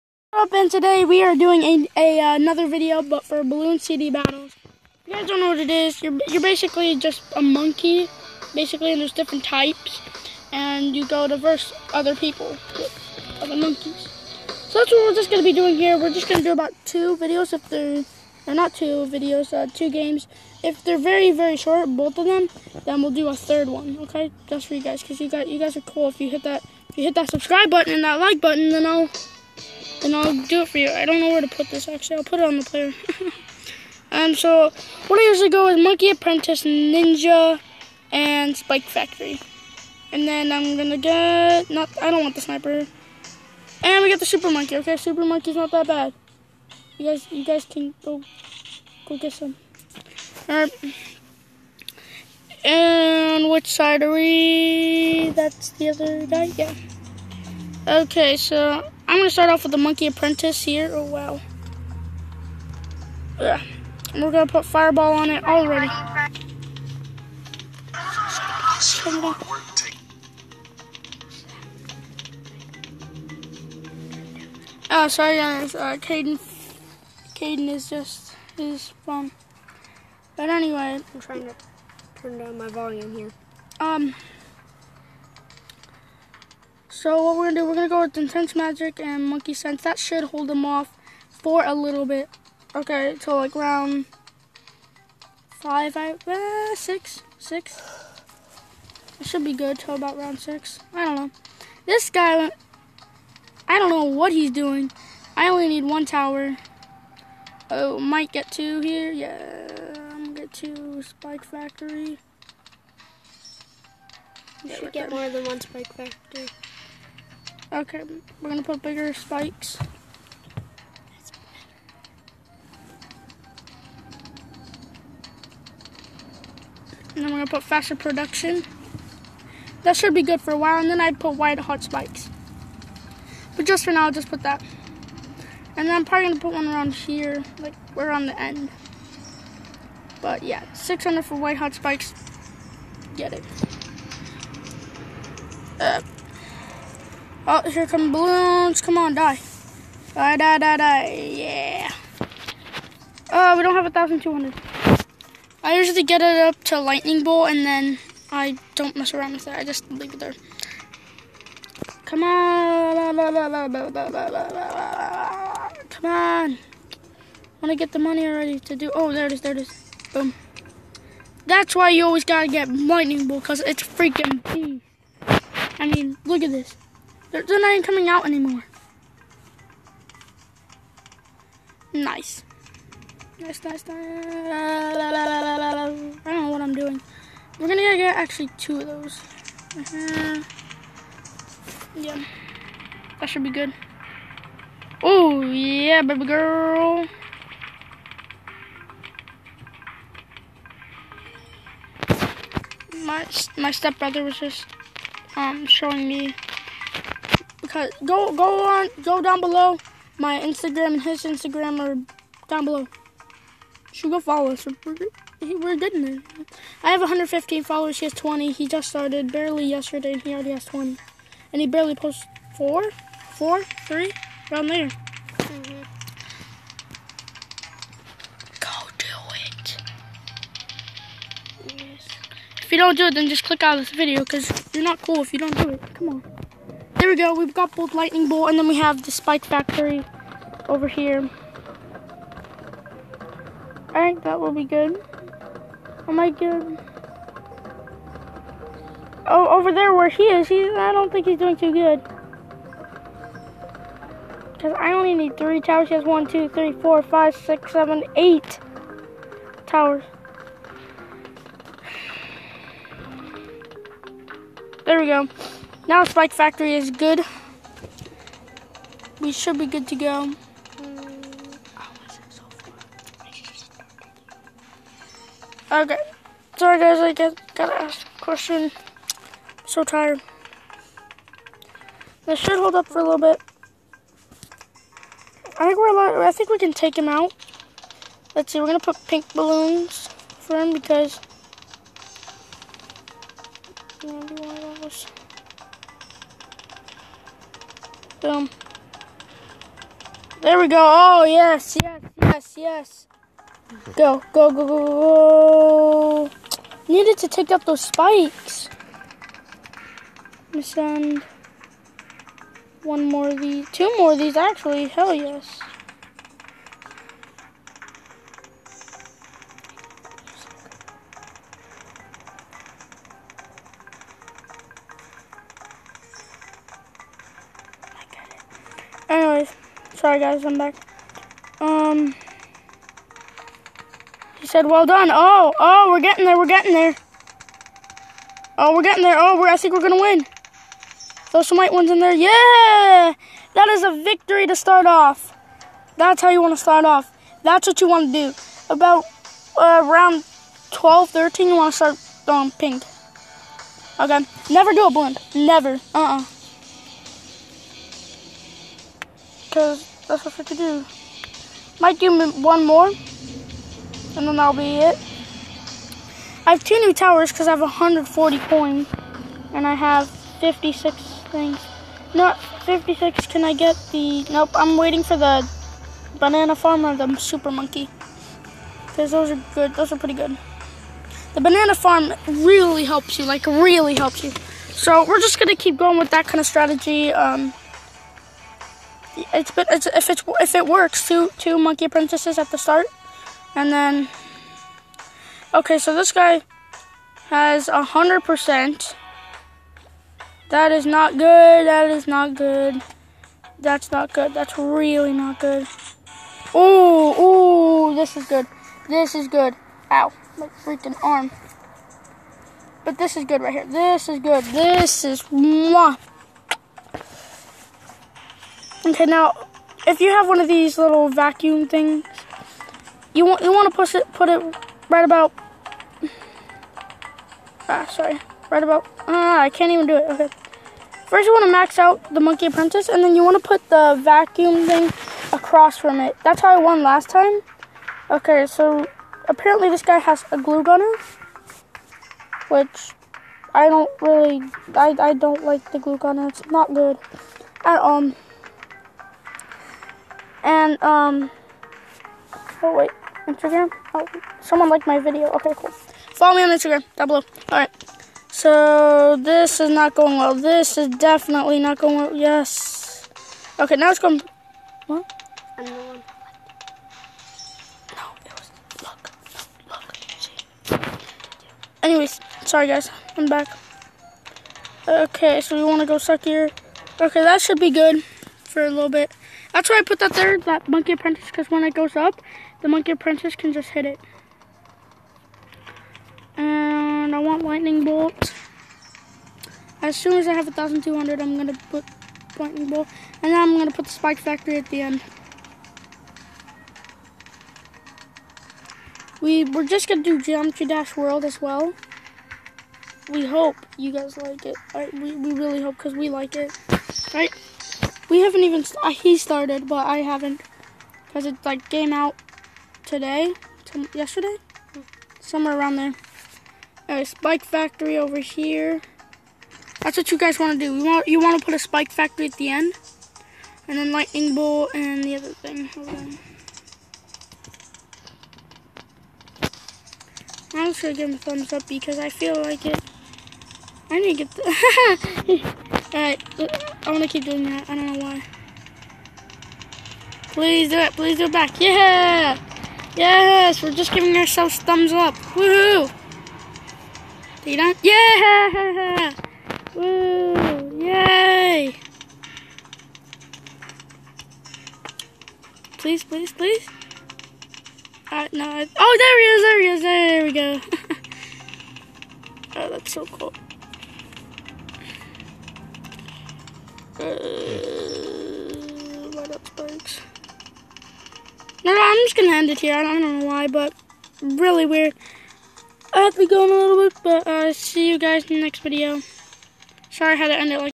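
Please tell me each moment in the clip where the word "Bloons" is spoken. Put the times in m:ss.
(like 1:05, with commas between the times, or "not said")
0:03.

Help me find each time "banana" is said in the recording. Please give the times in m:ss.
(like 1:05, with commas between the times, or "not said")
6:16, 6:21.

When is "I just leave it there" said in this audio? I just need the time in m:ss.
2:39.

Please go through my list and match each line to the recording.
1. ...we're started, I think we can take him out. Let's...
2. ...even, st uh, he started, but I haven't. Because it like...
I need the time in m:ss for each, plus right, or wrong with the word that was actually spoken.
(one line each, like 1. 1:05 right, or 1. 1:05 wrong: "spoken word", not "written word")
1. 4:45 wrong: "allowed", not "started"
2. 8:28 right.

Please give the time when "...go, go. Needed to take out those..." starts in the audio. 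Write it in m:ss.
5:04.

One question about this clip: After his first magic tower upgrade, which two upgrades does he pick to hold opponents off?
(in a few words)
Intense Magic and Monkey Sense.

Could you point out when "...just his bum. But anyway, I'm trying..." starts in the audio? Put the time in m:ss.
1:17.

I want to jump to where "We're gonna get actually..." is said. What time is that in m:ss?
3:07.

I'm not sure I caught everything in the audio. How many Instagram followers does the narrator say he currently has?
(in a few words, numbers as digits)
115.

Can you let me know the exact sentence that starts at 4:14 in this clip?
Because I only need three towers.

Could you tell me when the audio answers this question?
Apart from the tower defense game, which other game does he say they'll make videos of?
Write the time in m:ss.
8:20.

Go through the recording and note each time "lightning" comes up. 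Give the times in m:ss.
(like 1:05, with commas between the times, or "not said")
2:36, 2:52, 3:57, 8:07, 8:12, 8:43.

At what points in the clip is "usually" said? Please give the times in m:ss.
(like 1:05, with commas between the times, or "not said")
0:35, 2:35.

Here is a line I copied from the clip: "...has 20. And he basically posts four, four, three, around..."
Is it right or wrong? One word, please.
wrong.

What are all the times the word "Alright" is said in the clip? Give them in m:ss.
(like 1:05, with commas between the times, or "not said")
0:50, 8:55, 9:18.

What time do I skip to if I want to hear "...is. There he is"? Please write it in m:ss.
9:19.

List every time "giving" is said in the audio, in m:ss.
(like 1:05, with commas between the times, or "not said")
9:03.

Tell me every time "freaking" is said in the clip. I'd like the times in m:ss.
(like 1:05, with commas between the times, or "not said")
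2:53, 6:50.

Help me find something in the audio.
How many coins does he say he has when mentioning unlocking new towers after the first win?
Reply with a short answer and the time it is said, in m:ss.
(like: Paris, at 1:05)
140, at 6:07.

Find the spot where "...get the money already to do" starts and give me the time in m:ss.
2:47.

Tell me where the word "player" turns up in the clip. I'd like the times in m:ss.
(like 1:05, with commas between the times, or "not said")
0:32.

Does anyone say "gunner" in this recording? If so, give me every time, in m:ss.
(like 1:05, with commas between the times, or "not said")
7:20, 7:25.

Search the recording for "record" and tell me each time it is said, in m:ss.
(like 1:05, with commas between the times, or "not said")
not said.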